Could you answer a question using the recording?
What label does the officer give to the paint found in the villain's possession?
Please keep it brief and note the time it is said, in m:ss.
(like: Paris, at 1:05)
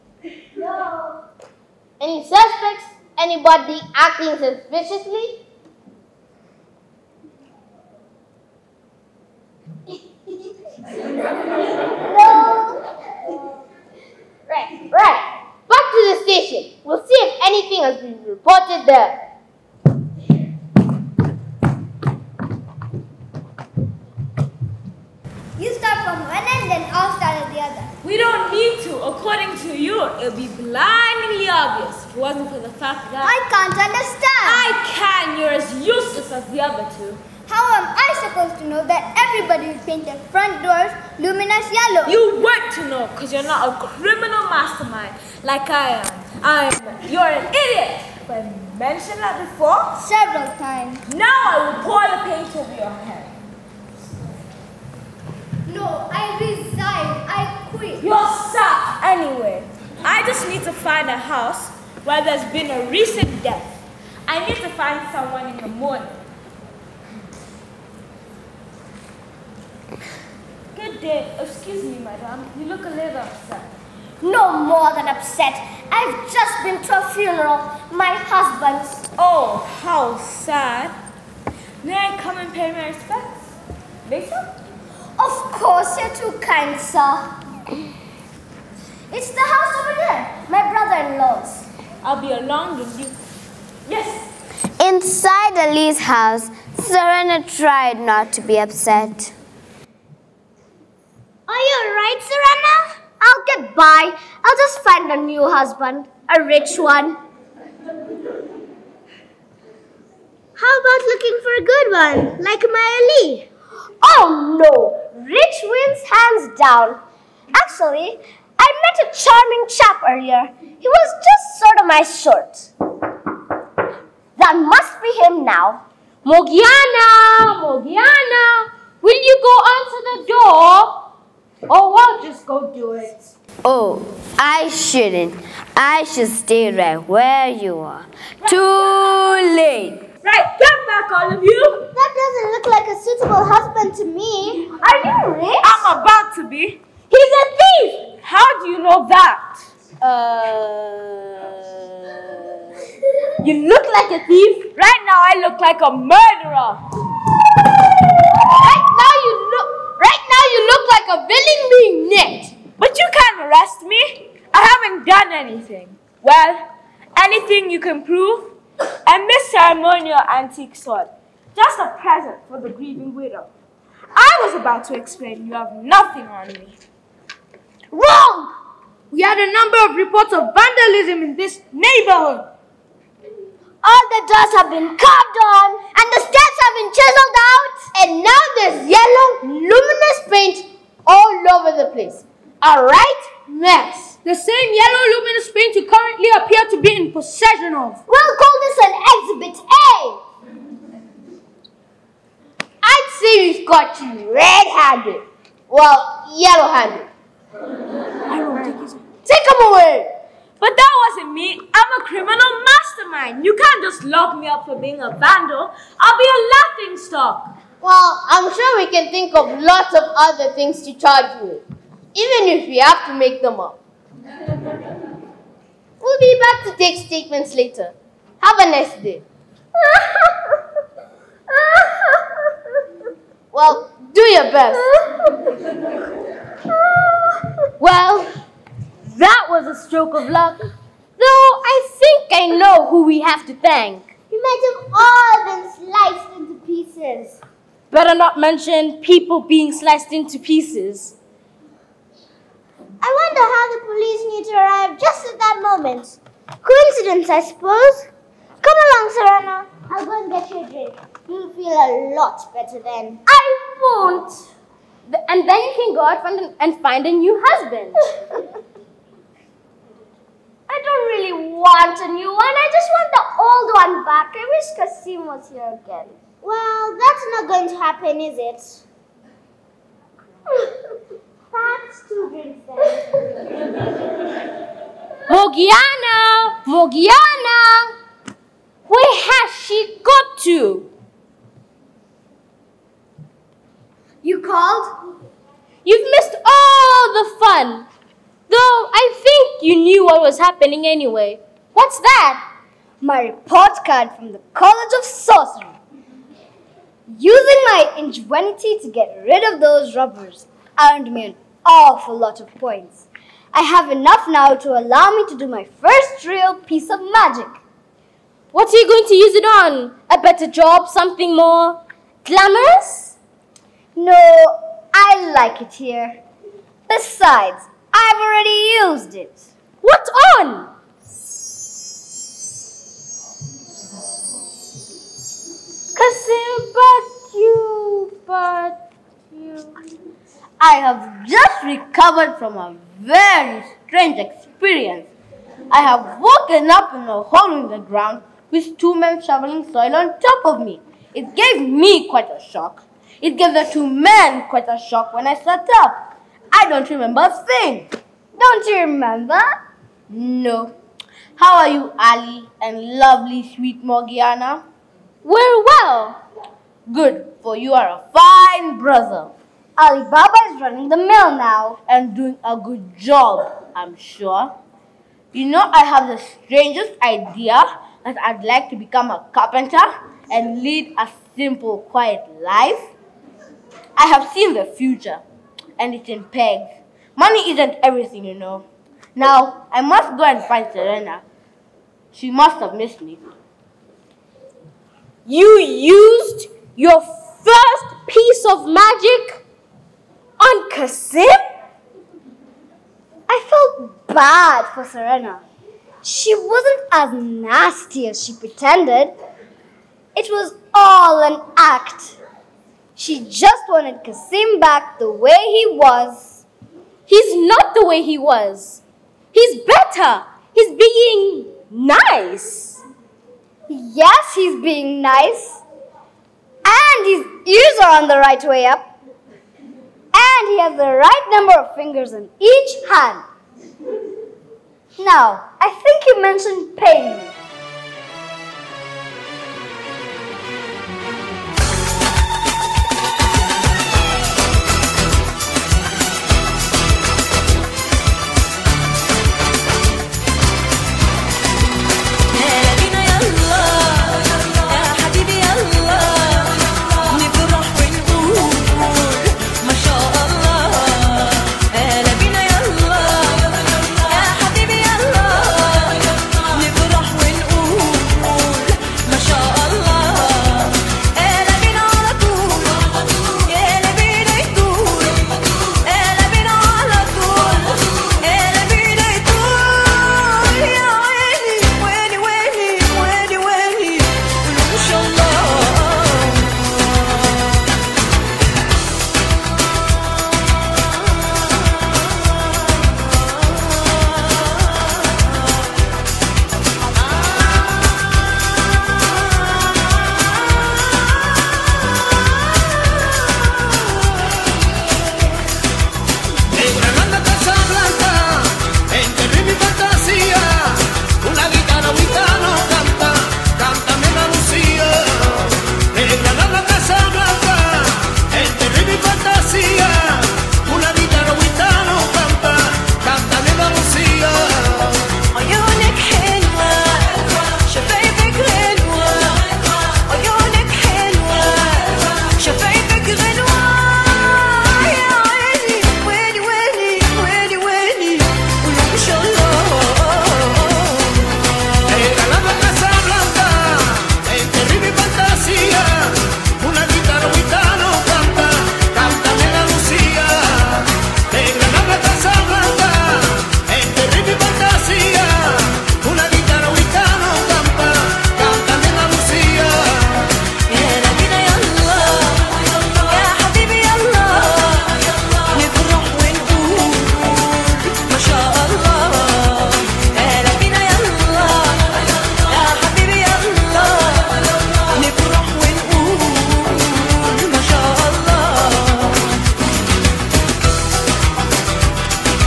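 Exhibit A, at 3:19.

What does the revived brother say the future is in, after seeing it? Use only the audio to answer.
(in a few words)
pegs.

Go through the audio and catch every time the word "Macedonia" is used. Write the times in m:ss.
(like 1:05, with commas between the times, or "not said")
not said.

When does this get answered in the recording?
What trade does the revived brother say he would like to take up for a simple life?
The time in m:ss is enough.
6:19.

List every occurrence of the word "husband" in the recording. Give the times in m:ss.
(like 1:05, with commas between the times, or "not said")
1:18, 1:45, 2:23, 4:27.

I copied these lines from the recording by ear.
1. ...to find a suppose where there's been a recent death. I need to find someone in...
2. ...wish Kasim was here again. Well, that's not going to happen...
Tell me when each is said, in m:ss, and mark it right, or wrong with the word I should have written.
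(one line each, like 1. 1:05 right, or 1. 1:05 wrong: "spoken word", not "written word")
1. 1:00 wrong: "house", not "suppose"
2. 4:34 right.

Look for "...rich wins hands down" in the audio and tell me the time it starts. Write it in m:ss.
1:55.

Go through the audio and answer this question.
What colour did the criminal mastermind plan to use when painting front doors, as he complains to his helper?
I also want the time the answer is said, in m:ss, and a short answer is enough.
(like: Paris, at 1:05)
luminous yellow, at 0:41.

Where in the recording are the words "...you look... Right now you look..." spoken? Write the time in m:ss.
2:39.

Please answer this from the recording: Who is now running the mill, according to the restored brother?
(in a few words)
Ali Baba.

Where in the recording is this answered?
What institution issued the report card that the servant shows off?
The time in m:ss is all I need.
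5:04.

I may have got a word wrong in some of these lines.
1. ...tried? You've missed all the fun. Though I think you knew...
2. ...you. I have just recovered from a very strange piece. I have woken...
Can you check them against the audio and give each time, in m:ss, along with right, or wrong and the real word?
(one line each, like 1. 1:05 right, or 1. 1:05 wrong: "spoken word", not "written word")
1. 4:54 wrong: "called", not "tried"
2. 5:39 wrong: "experience", not "piece".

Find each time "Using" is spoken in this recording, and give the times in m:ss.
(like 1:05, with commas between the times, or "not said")
5:07.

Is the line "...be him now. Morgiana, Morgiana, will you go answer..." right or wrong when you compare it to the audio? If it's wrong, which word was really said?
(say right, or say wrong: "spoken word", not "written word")
right.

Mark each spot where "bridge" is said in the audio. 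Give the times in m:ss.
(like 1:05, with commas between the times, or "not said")
not said.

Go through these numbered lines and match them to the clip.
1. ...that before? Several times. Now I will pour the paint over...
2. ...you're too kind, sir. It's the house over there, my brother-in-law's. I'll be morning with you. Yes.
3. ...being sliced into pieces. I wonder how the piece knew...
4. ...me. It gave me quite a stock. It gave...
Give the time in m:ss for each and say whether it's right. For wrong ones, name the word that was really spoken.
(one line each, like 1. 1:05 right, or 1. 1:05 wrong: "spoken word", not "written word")
1. 0:49 right
2. 1:25 wrong: "along", not "morning"
3. 4:09 wrong: "police", not "piece"
4. 5:50 wrong: "shock", not "stock".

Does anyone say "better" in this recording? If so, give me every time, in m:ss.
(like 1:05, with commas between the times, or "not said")
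4:07, 4:22, 5:20, 6:59.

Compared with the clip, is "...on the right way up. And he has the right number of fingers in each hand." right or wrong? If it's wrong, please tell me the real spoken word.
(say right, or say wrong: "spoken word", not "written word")
right.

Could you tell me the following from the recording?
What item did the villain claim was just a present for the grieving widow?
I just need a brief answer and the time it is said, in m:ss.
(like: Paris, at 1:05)
ceremonial antique sword, at 2:49.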